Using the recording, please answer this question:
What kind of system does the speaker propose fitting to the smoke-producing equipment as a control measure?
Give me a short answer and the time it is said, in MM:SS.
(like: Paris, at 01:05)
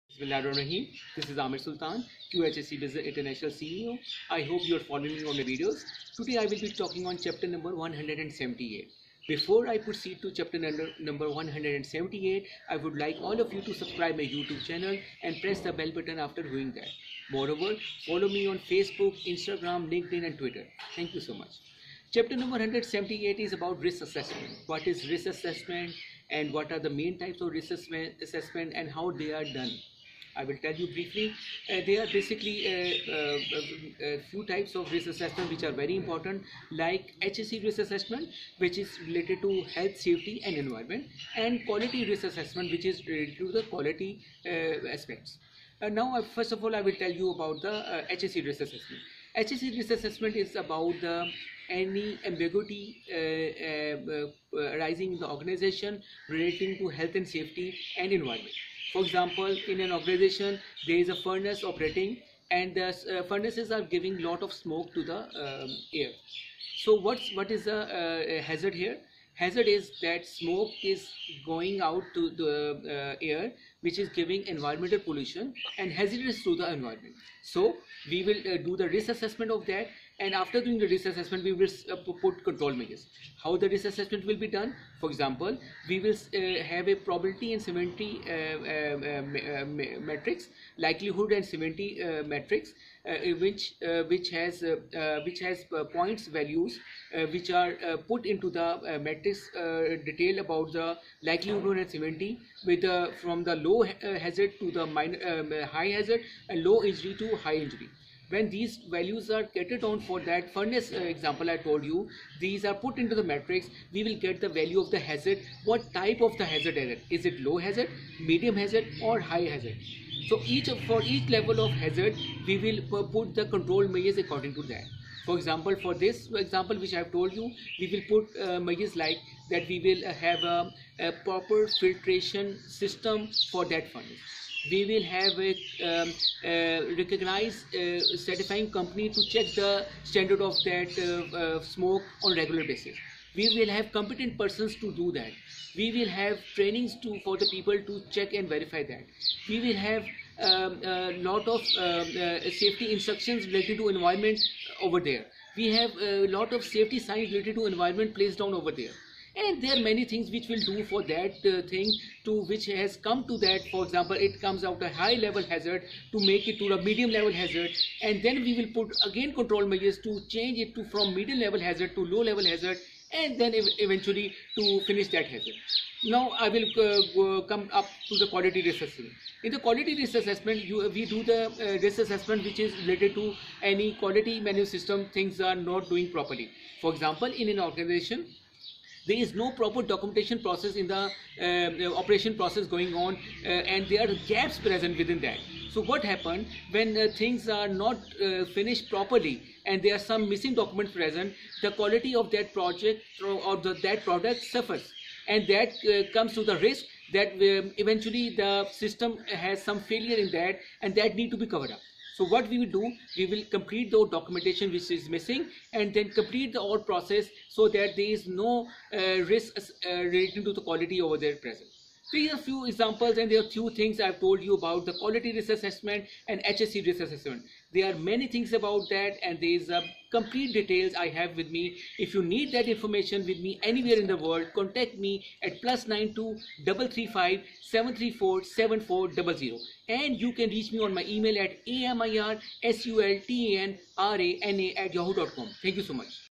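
Filtration system, at 02:11.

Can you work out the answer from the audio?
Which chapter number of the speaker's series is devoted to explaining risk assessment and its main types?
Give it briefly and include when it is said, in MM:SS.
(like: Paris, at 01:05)
178, at 00:22.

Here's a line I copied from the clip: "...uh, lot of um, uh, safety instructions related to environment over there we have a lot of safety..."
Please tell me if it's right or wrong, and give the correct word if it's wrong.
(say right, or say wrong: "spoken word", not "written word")
right.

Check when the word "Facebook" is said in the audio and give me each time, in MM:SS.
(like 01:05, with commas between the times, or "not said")
00:18.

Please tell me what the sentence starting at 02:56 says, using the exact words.
Now I will uh, come up to the quality risk assessment.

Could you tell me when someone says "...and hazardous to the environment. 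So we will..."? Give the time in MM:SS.
01:15.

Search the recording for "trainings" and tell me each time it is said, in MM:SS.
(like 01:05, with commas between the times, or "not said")
02:26.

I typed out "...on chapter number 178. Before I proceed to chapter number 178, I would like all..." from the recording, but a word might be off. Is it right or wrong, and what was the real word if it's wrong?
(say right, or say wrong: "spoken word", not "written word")
right.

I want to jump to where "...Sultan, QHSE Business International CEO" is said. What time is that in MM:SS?
00:01.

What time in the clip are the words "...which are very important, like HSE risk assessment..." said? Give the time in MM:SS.
00:35.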